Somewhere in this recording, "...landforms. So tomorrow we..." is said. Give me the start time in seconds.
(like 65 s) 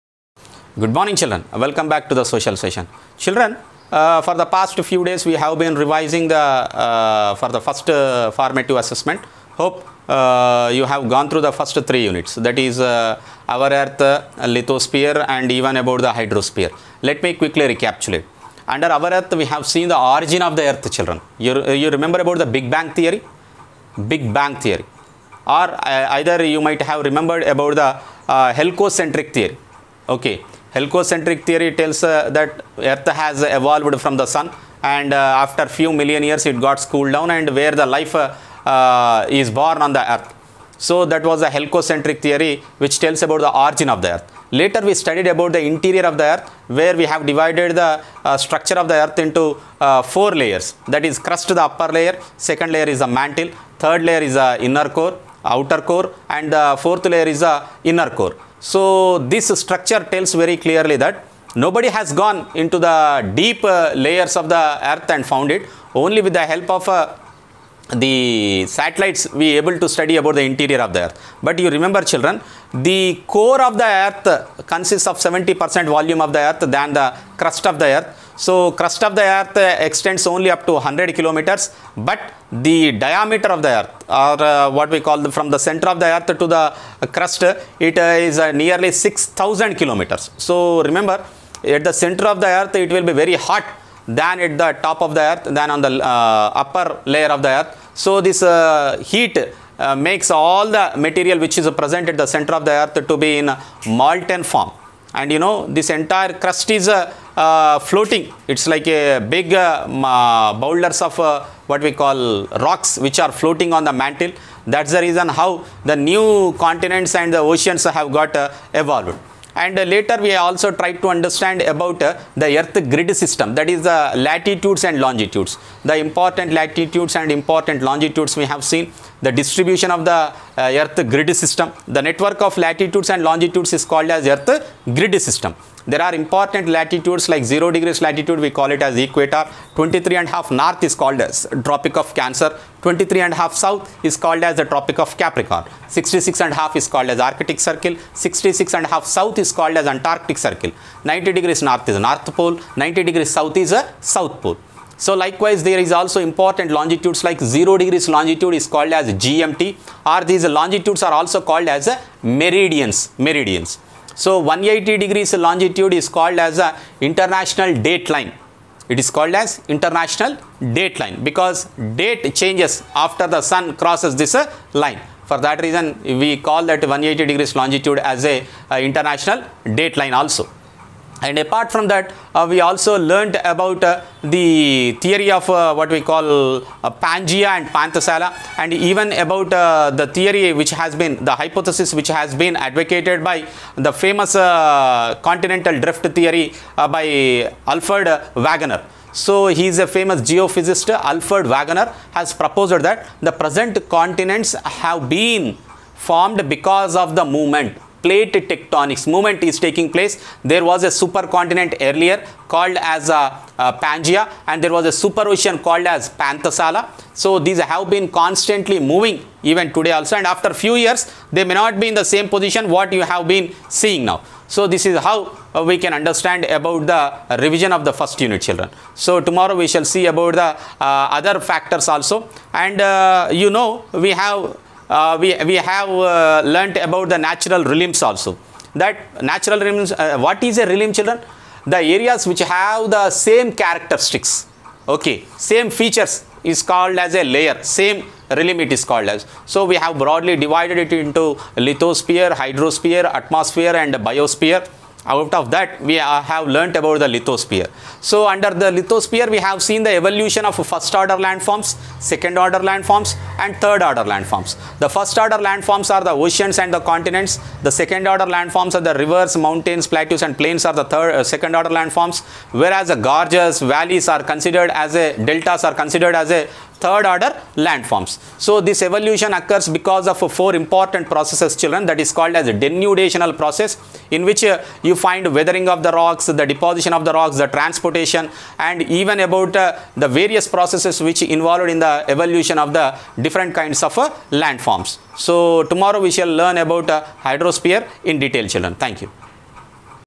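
294 s.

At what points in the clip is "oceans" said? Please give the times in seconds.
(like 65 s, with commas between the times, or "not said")
117 s, 215 s, 266 s.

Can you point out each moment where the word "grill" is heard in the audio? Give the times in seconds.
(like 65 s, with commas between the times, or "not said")
not said.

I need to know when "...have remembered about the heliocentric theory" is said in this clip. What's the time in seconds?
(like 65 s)
26 s.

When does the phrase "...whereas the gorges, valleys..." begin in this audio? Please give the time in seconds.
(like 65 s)
272 s.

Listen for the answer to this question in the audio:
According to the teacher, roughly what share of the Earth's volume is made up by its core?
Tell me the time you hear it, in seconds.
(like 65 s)
75 s.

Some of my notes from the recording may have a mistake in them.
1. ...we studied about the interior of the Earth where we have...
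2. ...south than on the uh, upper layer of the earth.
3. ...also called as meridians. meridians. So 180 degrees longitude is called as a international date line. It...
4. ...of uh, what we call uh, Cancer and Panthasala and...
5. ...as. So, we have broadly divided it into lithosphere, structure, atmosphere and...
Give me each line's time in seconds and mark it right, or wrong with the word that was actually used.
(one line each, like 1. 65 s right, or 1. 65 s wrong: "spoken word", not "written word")
1. 44 s right
2. 95 s wrong: "earth", not "south"
3. 161 s right
4. 185 s wrong: "Pangea", not "Cancer"
5. 249 s wrong: "hydrosphere", not "structure".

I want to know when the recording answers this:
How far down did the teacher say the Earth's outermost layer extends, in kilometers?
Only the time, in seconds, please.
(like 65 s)
80 s.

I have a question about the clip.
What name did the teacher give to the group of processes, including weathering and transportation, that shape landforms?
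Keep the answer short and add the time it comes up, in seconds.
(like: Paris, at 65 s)
denudational process, at 282 s.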